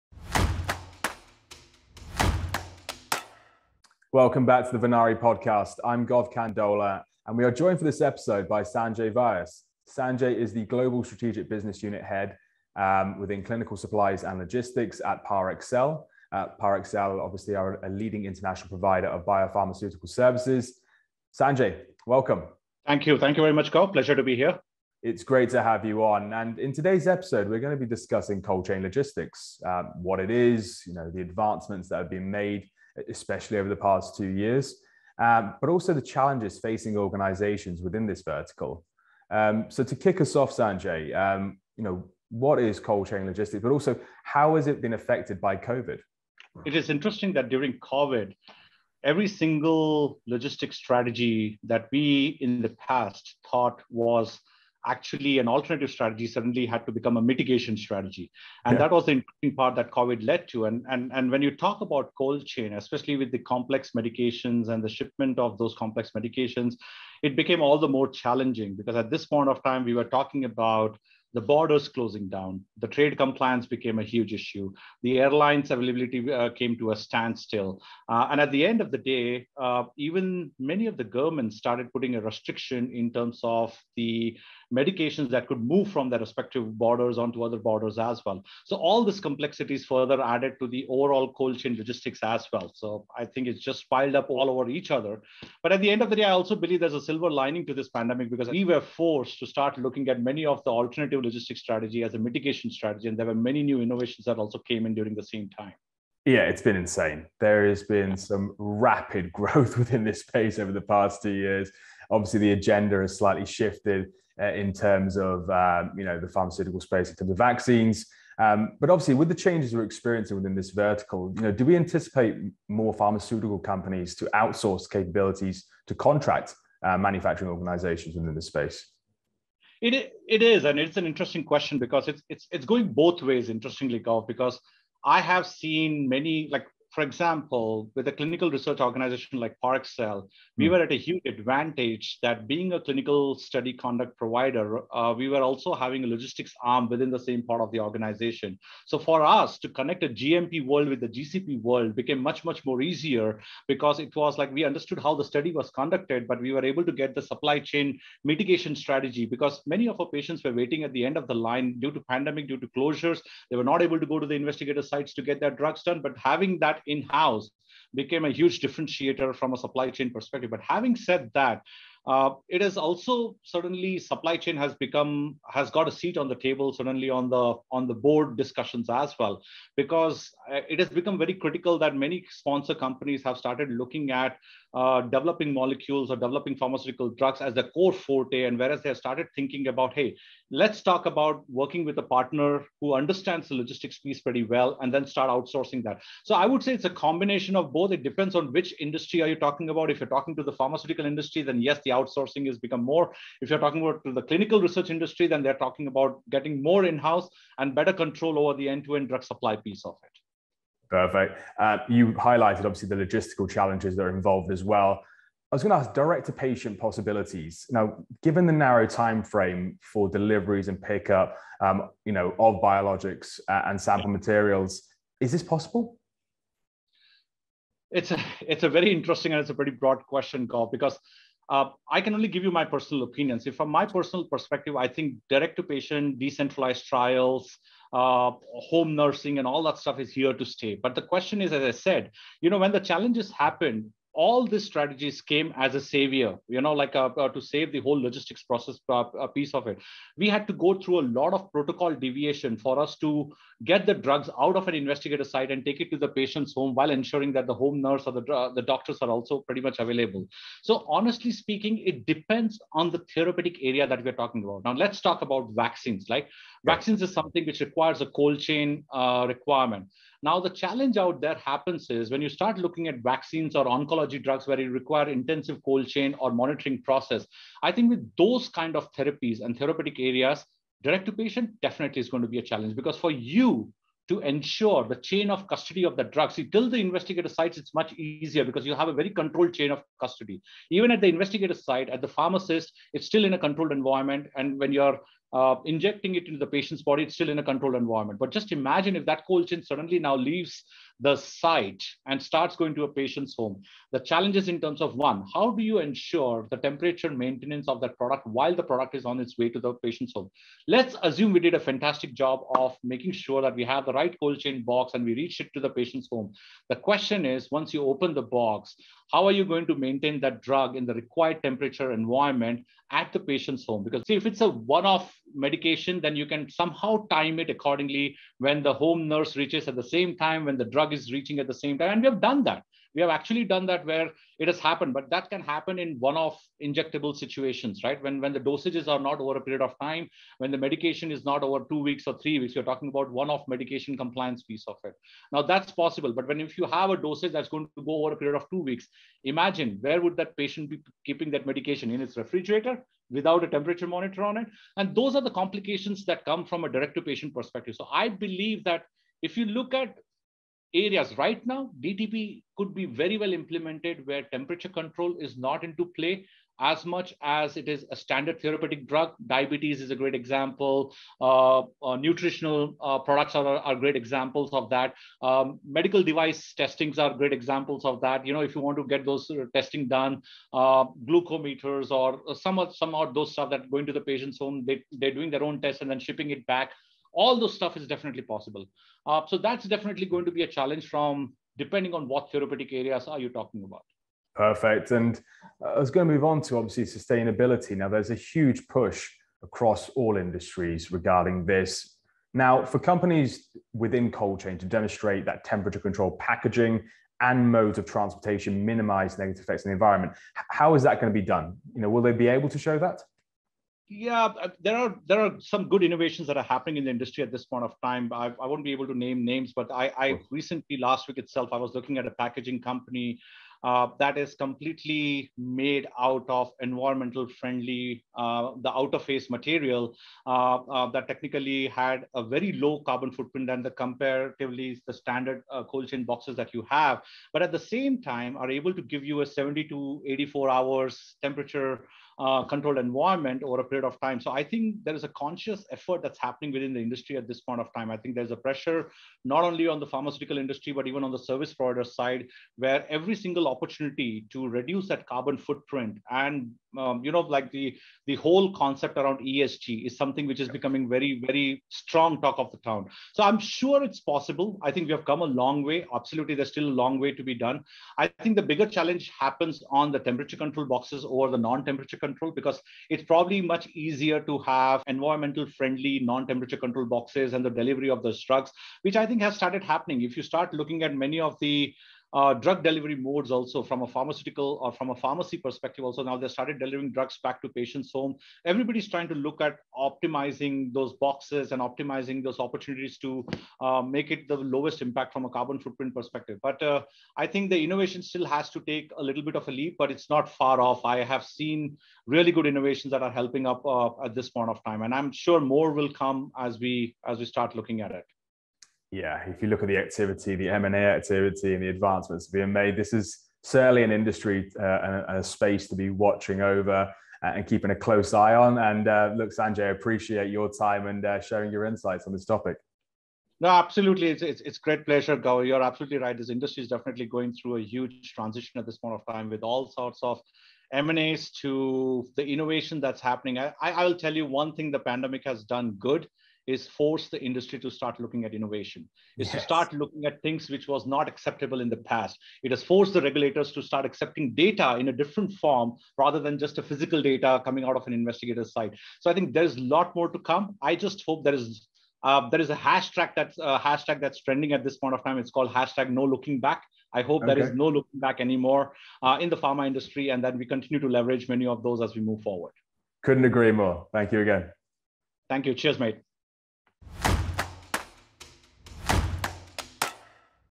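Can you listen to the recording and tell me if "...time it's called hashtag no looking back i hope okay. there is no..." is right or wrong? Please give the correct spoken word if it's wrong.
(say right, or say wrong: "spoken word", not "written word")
right.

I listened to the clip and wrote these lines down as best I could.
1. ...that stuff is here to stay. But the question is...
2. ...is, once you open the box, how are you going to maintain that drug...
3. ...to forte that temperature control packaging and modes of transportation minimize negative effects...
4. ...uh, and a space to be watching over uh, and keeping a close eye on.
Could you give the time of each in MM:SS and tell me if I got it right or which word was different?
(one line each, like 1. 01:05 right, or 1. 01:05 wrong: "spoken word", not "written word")
1. 03:59 right
2. 05:17 right
3. 06:44 wrong: "demonstrate", not "forte"
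4. 08:34 right.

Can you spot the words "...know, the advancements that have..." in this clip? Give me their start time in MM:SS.
00:30.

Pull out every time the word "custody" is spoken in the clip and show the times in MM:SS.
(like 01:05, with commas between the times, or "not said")
04:45, 04:49.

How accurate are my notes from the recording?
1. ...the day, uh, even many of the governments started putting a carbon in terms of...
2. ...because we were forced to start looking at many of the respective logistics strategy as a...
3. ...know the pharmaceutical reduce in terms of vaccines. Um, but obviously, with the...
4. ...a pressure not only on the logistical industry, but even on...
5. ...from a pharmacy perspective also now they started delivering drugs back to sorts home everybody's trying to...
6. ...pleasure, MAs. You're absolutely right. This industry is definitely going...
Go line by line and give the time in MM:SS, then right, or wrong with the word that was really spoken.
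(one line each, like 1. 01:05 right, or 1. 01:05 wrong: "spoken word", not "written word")
1. 01:18 wrong: "restriction", not "carbon"
2. 01:38 wrong: "alternative", not "respective"
3. 01:56 wrong: "space", not "reduce"
4. 07:28 wrong: "pharmaceutical", not "logistical"
5. 08:04 wrong: "patients", not "sorts"
6. 08:44 wrong: "Gov", not "MAs".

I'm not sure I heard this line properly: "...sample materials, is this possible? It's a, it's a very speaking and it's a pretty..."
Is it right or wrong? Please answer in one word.
wrong.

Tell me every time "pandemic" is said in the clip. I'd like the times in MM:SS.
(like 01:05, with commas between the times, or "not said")
01:37, 02:42, 08:54.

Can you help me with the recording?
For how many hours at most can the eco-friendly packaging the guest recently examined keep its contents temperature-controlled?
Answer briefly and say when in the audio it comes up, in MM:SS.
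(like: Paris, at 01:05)
84, at 07:20.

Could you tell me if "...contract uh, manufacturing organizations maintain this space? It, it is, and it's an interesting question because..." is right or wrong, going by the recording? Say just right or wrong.
wrong.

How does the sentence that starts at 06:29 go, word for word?
Uh, so that's definitely going to be a challenge from depending on what therapeutic areas are you talking about.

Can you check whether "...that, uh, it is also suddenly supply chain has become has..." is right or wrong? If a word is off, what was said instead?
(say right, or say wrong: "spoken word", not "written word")
right.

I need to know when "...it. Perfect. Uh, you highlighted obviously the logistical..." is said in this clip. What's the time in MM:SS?
03:30.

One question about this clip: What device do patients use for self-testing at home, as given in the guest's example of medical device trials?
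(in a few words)
Glucometers.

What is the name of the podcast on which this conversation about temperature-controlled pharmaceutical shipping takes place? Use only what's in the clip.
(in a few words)
Venari.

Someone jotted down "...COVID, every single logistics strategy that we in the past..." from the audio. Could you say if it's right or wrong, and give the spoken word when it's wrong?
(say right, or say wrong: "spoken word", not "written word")
right.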